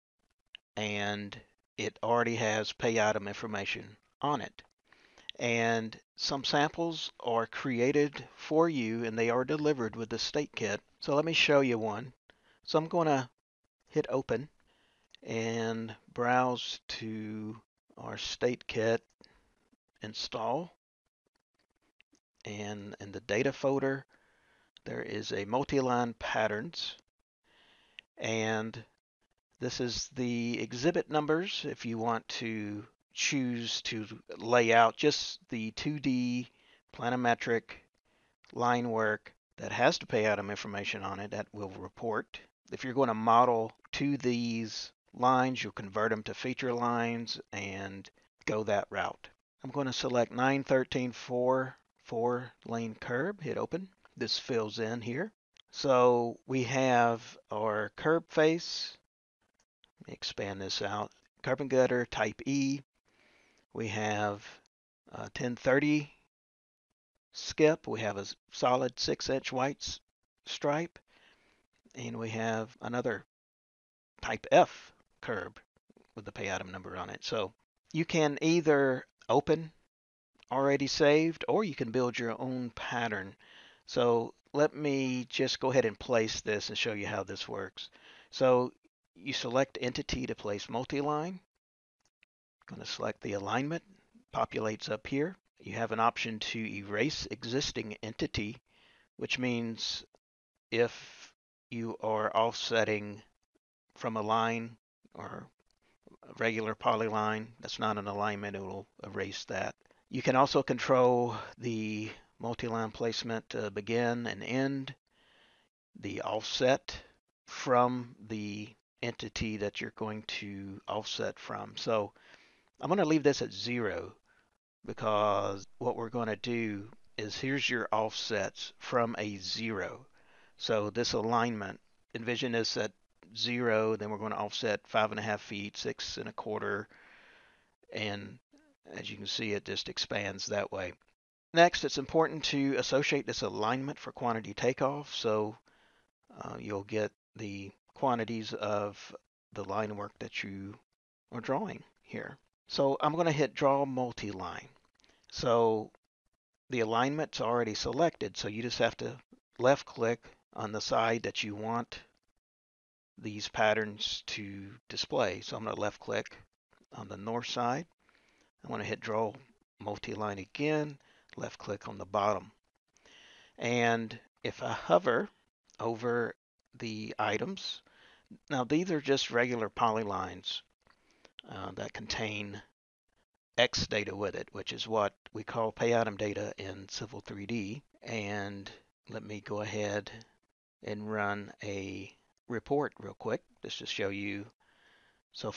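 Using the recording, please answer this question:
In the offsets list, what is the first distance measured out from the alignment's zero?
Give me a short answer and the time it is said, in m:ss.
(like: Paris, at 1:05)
5.5 feet, at 2:14.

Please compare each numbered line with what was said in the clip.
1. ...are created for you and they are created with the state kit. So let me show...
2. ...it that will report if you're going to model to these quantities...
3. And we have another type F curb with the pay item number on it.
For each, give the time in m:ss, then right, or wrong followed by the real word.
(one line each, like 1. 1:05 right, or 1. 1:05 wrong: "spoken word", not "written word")
1. 0:07 wrong: "delivered", not "created"
2. 0:41 wrong: "lines", not "quantities"
3. 1:11 right.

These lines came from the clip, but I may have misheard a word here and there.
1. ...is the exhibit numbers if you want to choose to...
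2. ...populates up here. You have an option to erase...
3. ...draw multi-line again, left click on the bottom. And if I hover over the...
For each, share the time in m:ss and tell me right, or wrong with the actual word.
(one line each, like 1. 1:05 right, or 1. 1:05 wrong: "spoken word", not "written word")
1. 0:29 right
2. 1:34 right
3. 2:48 right.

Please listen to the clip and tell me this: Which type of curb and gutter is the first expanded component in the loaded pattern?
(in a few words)
Type E.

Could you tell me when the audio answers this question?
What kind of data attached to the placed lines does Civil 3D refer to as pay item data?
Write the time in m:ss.
3:03.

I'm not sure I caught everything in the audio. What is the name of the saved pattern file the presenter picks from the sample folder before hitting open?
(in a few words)
913 4, 4 lane curb.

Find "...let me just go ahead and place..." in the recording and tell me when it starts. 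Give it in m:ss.
1:24.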